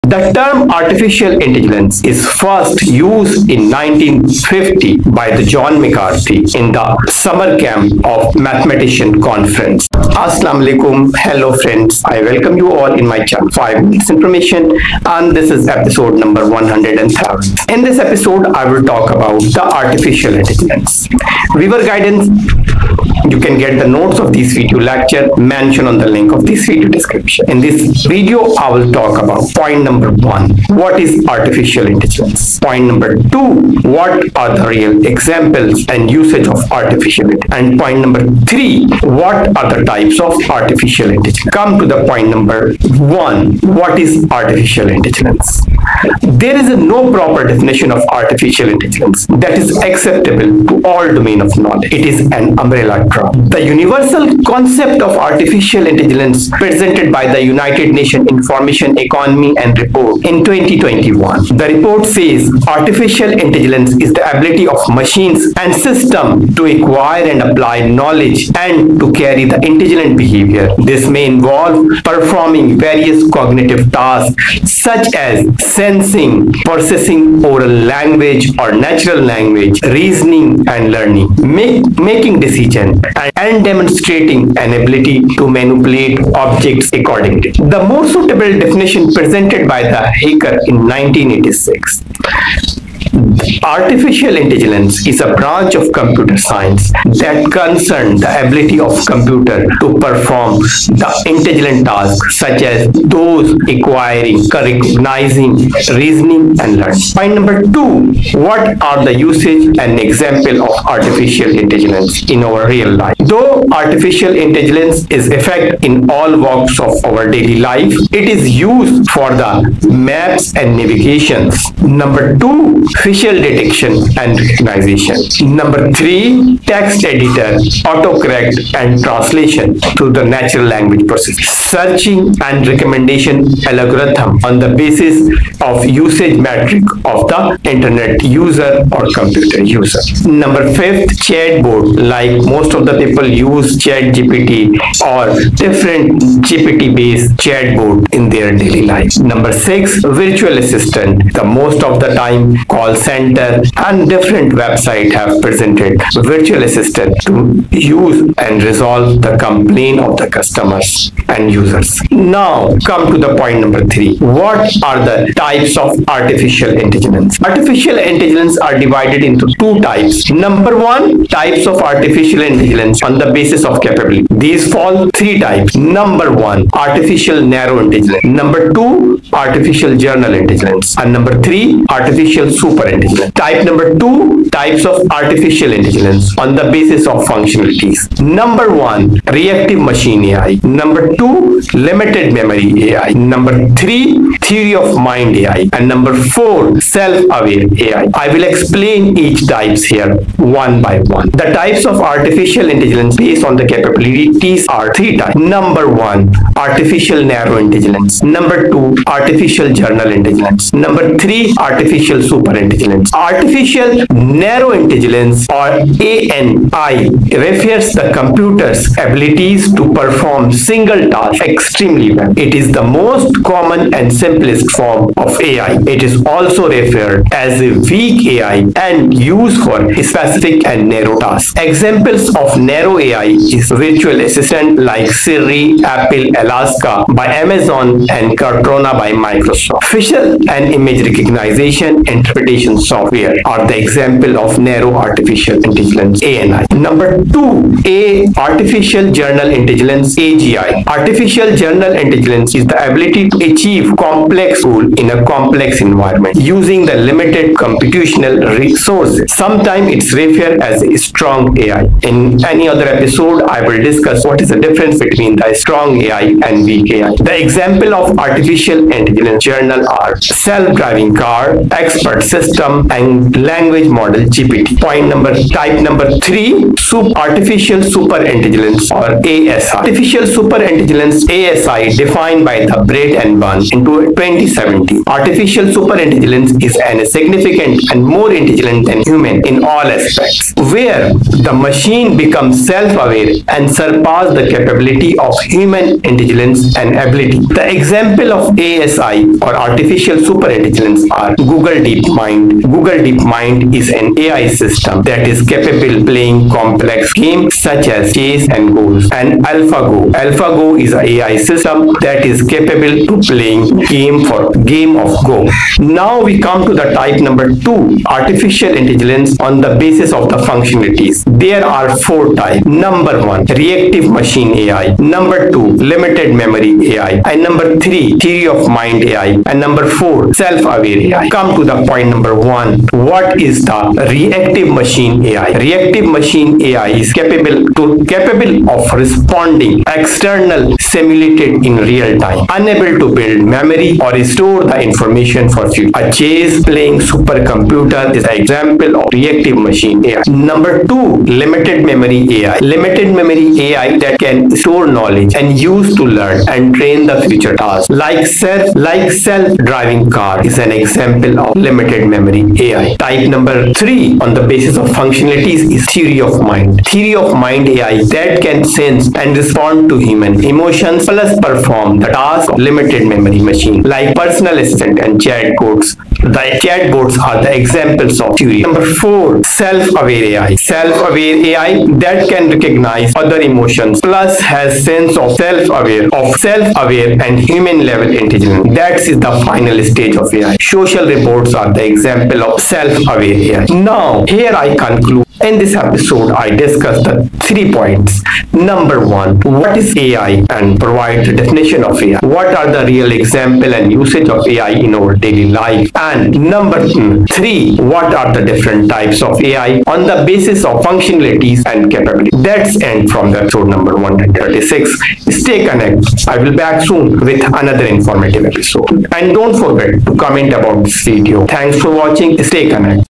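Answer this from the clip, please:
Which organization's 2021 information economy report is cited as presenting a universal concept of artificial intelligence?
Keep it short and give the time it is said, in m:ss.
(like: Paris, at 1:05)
United Nations, at 0:57.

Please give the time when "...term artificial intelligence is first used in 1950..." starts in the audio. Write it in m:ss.
0:00.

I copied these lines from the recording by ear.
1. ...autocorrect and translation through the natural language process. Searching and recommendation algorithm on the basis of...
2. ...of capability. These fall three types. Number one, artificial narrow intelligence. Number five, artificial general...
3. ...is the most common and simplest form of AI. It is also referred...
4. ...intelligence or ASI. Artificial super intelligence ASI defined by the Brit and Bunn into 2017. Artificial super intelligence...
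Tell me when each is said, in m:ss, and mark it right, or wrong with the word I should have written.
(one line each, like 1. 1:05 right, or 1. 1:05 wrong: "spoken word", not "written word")
1. 2:07 right
2. 2:53 wrong: "two", not "five"
3. 3:42 right
4. 4:38 right.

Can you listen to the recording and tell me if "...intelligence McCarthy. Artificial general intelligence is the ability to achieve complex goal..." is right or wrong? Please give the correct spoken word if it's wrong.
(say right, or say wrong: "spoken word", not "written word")
wrong: "AGI", not "McCarthy".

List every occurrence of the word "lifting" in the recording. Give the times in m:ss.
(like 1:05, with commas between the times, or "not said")
not said.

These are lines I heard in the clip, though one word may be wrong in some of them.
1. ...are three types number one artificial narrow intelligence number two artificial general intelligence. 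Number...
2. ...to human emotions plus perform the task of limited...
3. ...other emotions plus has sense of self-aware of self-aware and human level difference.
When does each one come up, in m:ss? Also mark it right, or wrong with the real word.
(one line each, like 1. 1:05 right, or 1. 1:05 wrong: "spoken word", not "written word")
1. 3:24 right
2. 6:09 right
3. 6:23 wrong: "intelligence", not "difference".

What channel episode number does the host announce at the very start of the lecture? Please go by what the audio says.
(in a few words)
103.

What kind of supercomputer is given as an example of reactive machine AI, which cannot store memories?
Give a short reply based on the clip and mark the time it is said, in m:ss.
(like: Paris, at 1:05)
chess playing supercomputer, at 5:46.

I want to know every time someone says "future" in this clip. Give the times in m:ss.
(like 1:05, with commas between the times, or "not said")
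5:45, 5:57.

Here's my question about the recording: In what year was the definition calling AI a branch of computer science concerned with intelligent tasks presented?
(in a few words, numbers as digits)
1986.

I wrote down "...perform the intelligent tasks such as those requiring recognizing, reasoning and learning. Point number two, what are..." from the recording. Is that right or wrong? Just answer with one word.
right.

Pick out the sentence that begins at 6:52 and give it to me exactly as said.
That's end from the episode number 136.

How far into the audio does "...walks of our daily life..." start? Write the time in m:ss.
1:56.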